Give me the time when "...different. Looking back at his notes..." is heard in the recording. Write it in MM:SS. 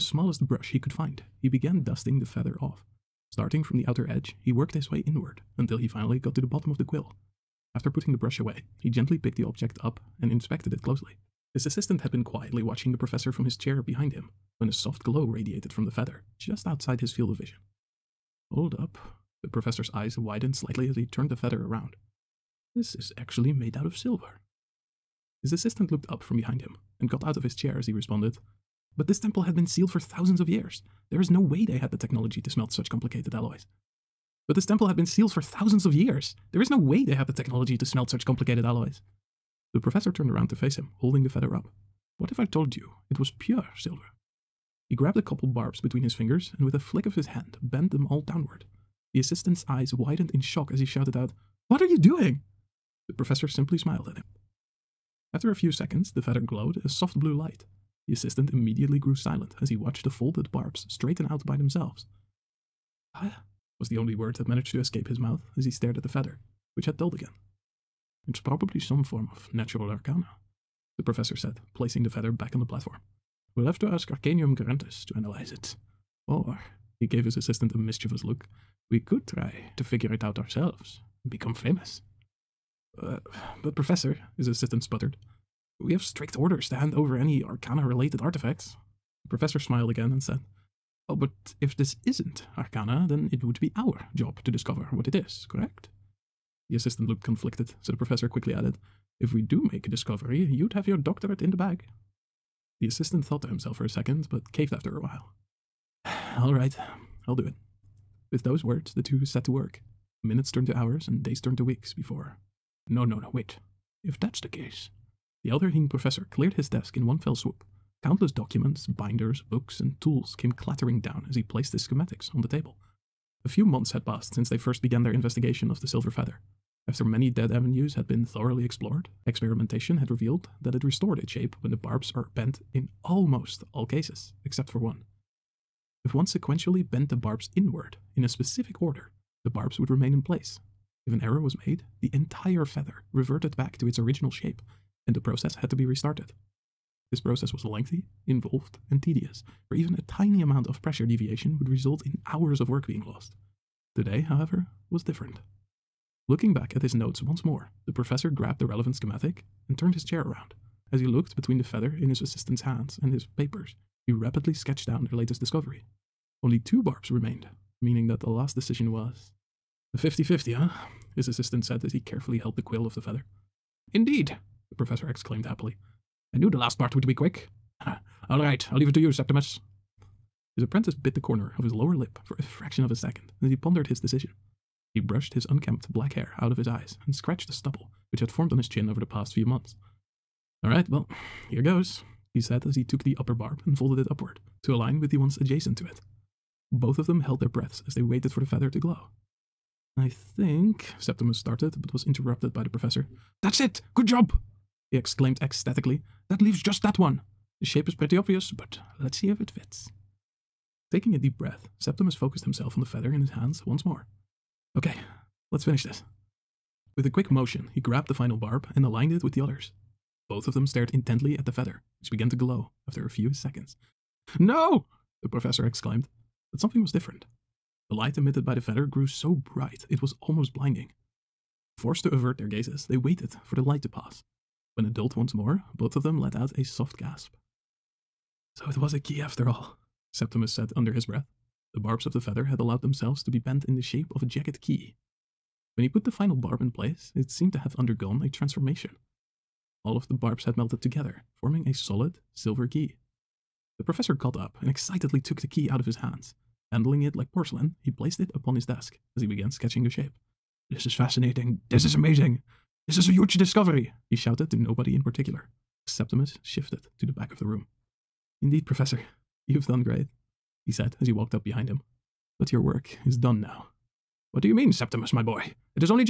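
02:35.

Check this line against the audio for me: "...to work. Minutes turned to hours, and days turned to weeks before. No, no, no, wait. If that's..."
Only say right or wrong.
right.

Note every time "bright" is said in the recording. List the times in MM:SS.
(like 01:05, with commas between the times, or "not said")
03:49.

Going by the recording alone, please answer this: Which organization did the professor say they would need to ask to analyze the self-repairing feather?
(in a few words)
Arcanium Garantis.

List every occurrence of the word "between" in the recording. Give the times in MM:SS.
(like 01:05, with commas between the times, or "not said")
00:45, 02:41.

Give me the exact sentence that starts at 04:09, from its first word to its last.
All of the barbs had melted together, forming a solid, silver key.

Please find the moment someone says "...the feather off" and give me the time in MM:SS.
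00:02.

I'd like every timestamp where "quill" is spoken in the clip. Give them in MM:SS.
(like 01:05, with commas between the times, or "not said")
00:06, 02:52.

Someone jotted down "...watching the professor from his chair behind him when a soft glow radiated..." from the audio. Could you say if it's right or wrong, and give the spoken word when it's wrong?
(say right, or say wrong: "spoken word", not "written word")
right.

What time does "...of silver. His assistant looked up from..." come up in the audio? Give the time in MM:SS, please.
00:23.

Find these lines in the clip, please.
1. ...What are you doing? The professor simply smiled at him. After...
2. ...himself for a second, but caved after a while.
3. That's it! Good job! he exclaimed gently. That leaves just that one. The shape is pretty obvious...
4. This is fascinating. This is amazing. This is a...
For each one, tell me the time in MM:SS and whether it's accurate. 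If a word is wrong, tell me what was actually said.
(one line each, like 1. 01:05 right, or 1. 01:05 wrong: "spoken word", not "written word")
1. 00:51 right
2. 01:43 right
3. 03:23 wrong: "ecstatically", not "gently"
4. 04:20 right.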